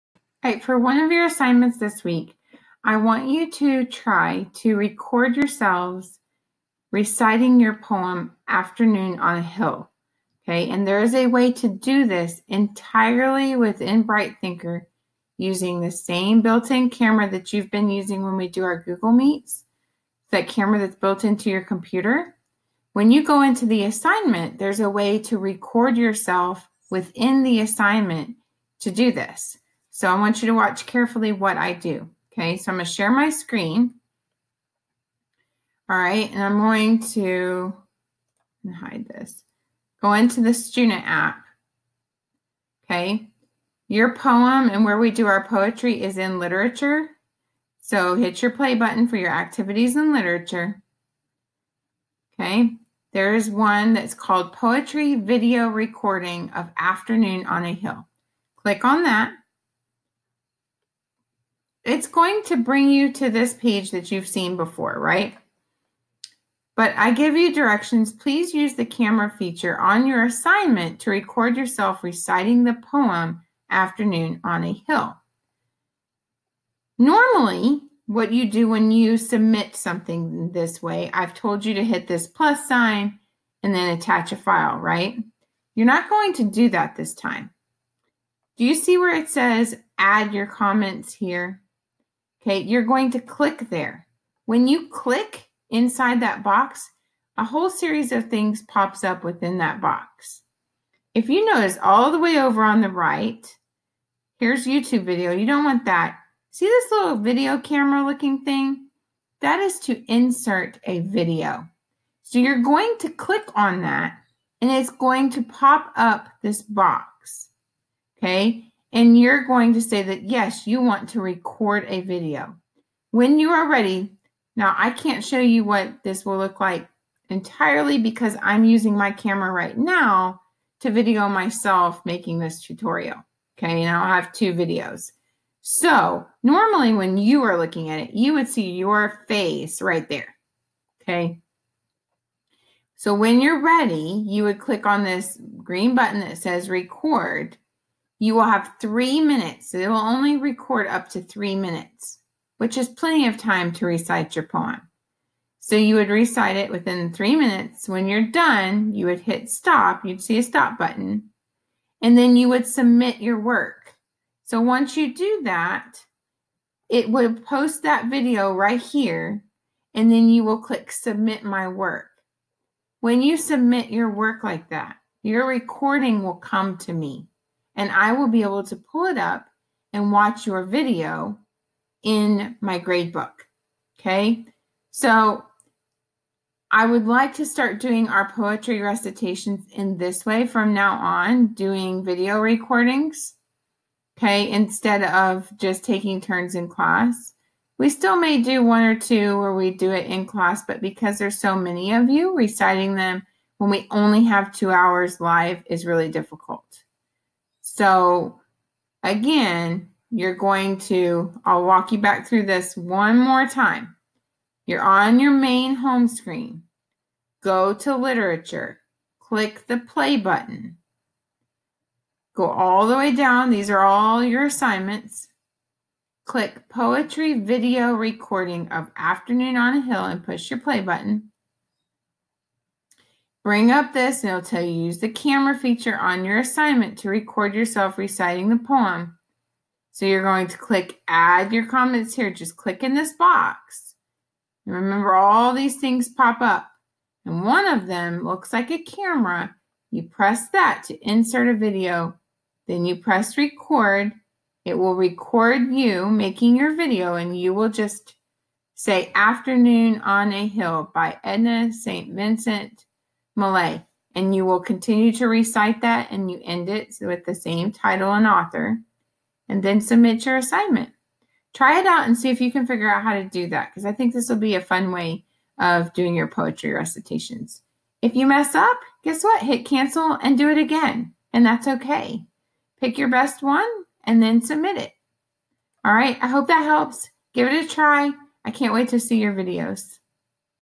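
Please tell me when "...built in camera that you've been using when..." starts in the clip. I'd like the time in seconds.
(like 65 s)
16 s.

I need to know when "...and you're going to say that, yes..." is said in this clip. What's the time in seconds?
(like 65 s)
118 s.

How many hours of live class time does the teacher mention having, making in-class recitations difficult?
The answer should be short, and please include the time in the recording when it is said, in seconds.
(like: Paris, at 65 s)
2, at 204 s.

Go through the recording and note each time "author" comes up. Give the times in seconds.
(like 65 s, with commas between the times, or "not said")
268 s.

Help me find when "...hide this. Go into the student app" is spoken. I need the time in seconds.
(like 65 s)
38 s.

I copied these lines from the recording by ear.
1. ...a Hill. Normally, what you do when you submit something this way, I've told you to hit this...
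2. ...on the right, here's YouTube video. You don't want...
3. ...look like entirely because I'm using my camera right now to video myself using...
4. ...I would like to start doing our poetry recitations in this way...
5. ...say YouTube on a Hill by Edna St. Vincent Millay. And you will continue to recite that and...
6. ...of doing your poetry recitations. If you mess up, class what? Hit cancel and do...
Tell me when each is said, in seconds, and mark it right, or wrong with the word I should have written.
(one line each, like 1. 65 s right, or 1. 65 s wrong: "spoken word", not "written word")
1. 74 s right
2. 102 s right
3. 126 s wrong: "making", not "using"
4. 186 s right
5. 258 s wrong: "Afternoon", not "YouTube"
6. 275 s wrong: "guess", not "class".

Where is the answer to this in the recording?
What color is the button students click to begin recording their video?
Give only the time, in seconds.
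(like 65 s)
145 s.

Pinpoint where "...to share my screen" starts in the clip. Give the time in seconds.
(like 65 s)
32 s.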